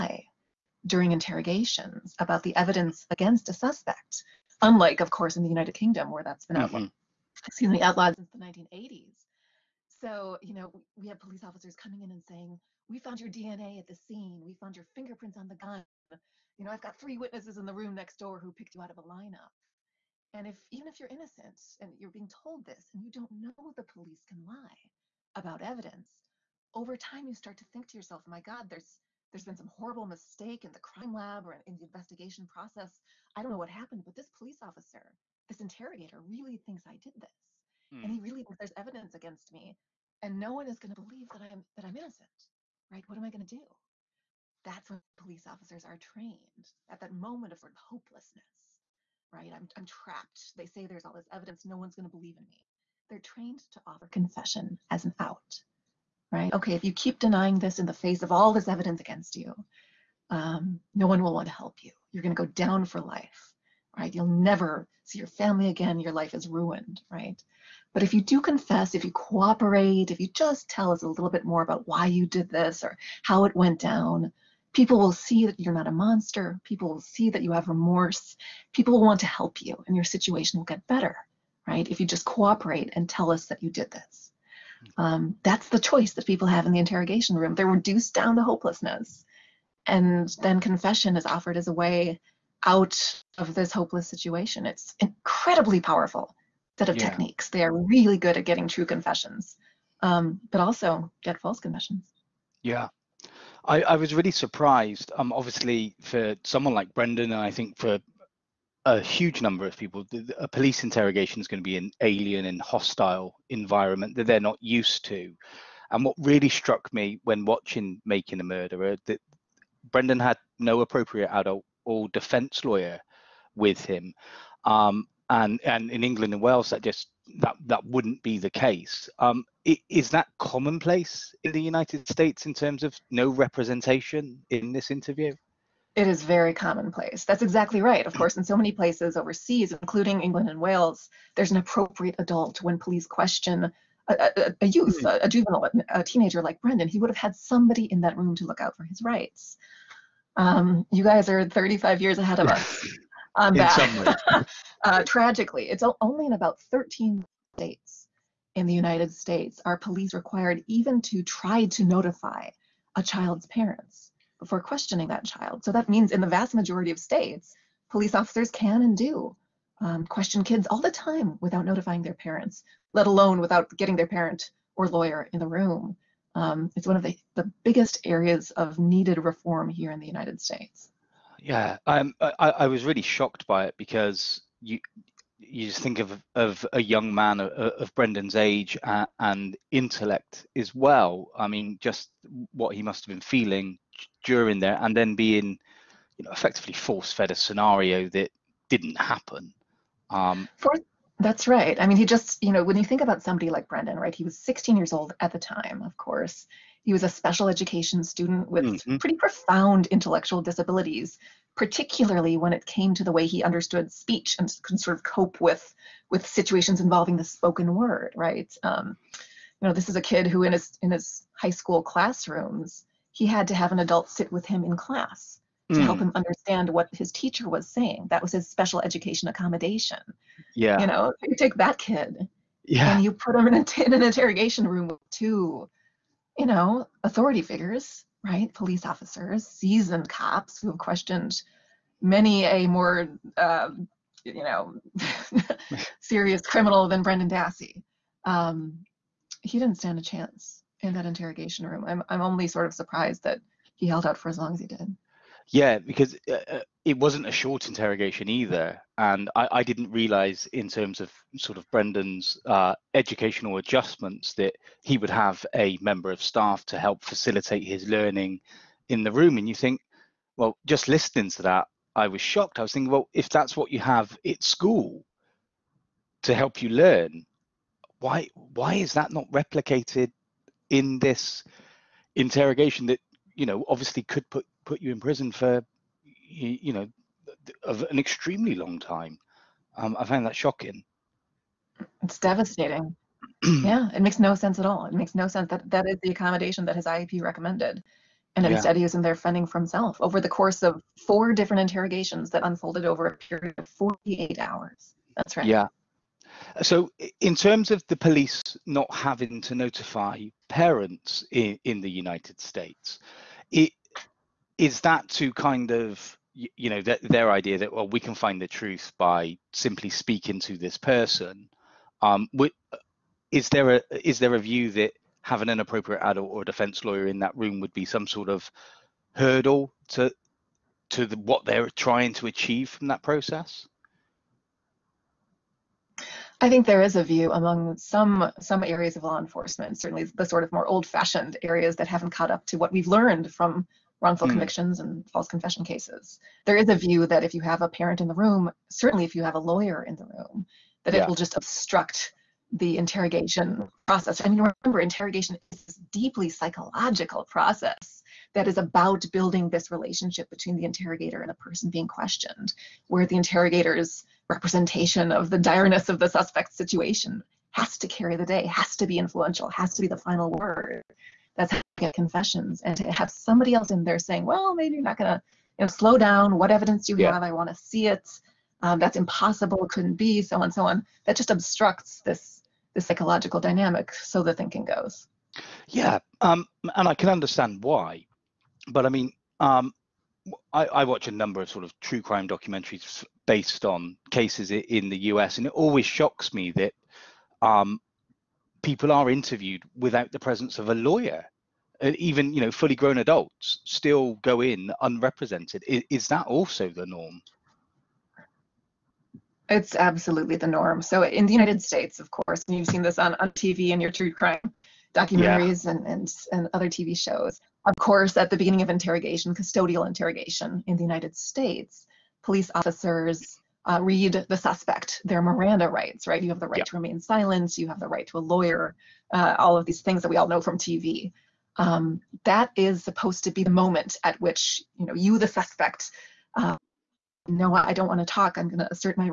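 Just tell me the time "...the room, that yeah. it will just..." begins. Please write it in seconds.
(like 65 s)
349 s.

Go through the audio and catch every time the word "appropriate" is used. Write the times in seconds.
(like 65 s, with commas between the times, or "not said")
120 s, 141 s, 325 s.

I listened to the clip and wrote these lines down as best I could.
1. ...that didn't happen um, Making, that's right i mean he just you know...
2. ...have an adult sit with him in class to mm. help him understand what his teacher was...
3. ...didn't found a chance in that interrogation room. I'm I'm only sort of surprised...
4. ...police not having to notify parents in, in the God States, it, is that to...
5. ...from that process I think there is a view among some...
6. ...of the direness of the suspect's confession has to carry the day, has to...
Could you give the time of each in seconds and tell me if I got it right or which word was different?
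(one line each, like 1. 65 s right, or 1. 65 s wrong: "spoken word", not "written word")
1. 198 s wrong: "For", not "Making"
2. 223 s right
3. 249 s wrong: "stand", not "found"
4. 307 s wrong: "United", not "God"
5. 332 s right
6. 365 s wrong: "situation", not "confession".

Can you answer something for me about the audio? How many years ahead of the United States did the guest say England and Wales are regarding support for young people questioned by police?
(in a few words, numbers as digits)
35.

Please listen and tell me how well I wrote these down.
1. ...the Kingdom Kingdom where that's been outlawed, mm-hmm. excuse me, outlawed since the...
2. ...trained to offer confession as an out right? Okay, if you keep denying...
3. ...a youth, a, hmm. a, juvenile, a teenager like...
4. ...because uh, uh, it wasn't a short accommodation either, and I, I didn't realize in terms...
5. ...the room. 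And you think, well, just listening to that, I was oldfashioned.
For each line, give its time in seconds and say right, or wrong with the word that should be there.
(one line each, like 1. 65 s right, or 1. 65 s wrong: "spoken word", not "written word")
1. 5 s wrong: "United", not "Kingdom"
2. 53 s right
3. 144 s right
4. 255 s wrong: "interrogation", not "accommodation"
5. 269 s wrong: "shocked", not "oldfashioned".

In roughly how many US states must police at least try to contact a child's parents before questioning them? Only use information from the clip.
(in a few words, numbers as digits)
13.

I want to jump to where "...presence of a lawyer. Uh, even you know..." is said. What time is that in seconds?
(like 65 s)
400 s.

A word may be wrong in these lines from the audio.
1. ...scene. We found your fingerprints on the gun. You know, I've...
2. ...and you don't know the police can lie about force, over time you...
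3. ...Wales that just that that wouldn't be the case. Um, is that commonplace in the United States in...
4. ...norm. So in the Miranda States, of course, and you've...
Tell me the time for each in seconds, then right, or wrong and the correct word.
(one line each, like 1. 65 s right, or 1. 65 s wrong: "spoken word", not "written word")
1. 13 s right
2. 22 s wrong: "evidence", not "force"
3. 126 s right
4. 410 s wrong: "United", not "Miranda".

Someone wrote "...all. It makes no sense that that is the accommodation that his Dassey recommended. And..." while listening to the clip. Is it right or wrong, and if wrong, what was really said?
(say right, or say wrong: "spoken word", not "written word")
wrong: "IEP", not "Dassey".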